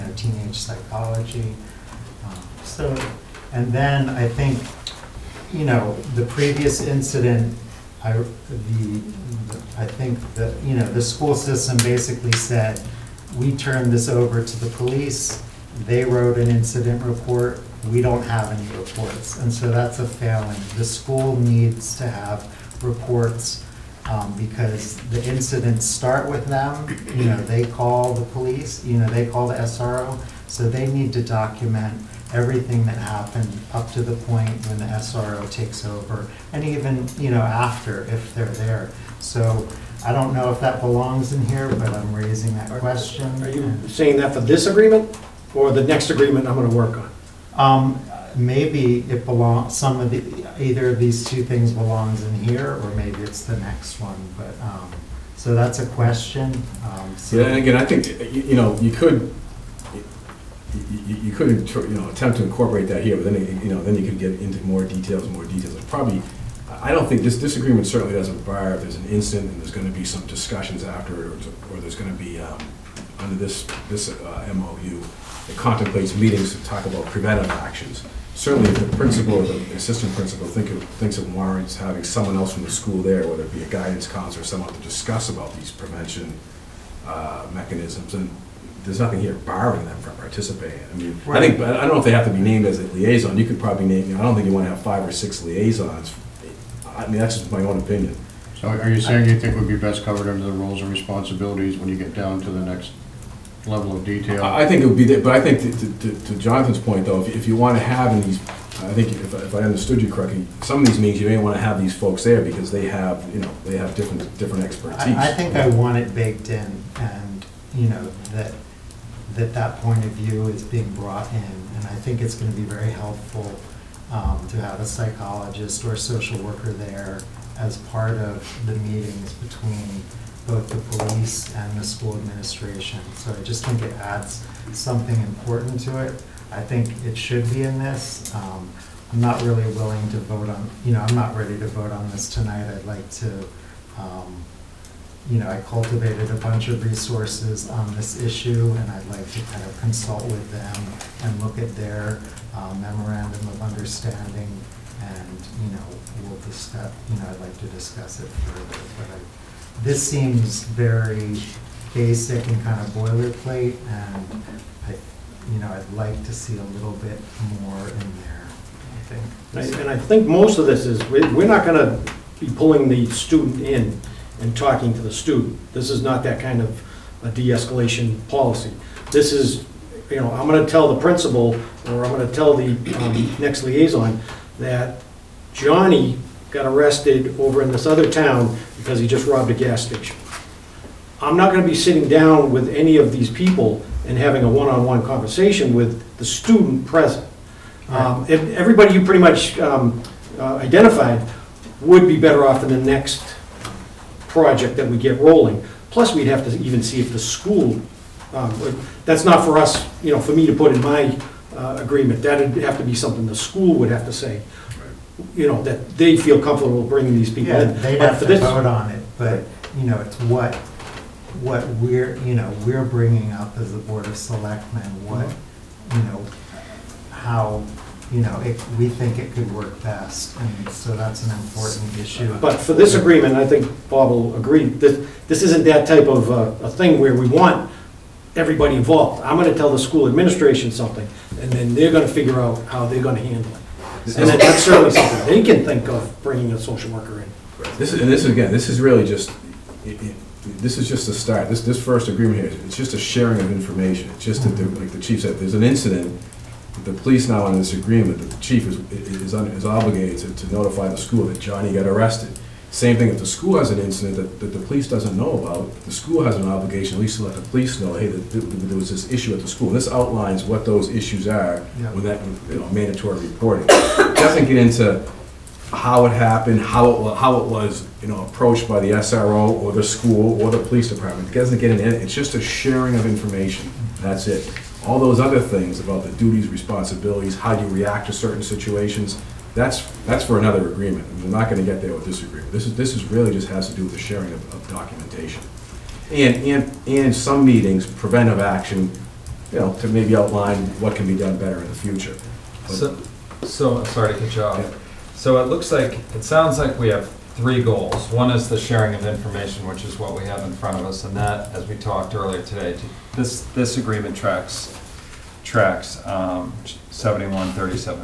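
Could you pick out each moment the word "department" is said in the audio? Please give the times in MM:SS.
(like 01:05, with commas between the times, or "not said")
04:40.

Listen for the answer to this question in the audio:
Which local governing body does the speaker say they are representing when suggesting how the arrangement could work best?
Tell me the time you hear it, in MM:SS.
03:43.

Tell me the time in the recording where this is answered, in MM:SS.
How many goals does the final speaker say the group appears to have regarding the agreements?
05:07.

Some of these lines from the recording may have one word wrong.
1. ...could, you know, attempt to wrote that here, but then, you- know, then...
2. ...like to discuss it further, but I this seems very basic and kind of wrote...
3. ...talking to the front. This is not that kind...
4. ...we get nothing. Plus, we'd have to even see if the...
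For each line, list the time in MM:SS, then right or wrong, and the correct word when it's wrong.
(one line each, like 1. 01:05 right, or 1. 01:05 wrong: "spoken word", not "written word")
1. 01:01 wrong: "incorporate", not "wrote"
2. 02:37 wrong: "boilerplate", not "wrote"
3. 02:54 wrong: "student", not "front"
4. 03:24 wrong: "rolling", not "nothing".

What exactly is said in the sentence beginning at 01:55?
I, I think I want it baked in and, you know, that, that that point of view is being brought in.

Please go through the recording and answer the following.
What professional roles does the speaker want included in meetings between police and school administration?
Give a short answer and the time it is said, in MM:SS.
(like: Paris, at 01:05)
psychologist or social worker, at 02:04.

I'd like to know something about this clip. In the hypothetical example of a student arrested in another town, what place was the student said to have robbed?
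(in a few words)
a gas station.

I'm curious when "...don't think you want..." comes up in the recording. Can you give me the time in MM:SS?
01:34.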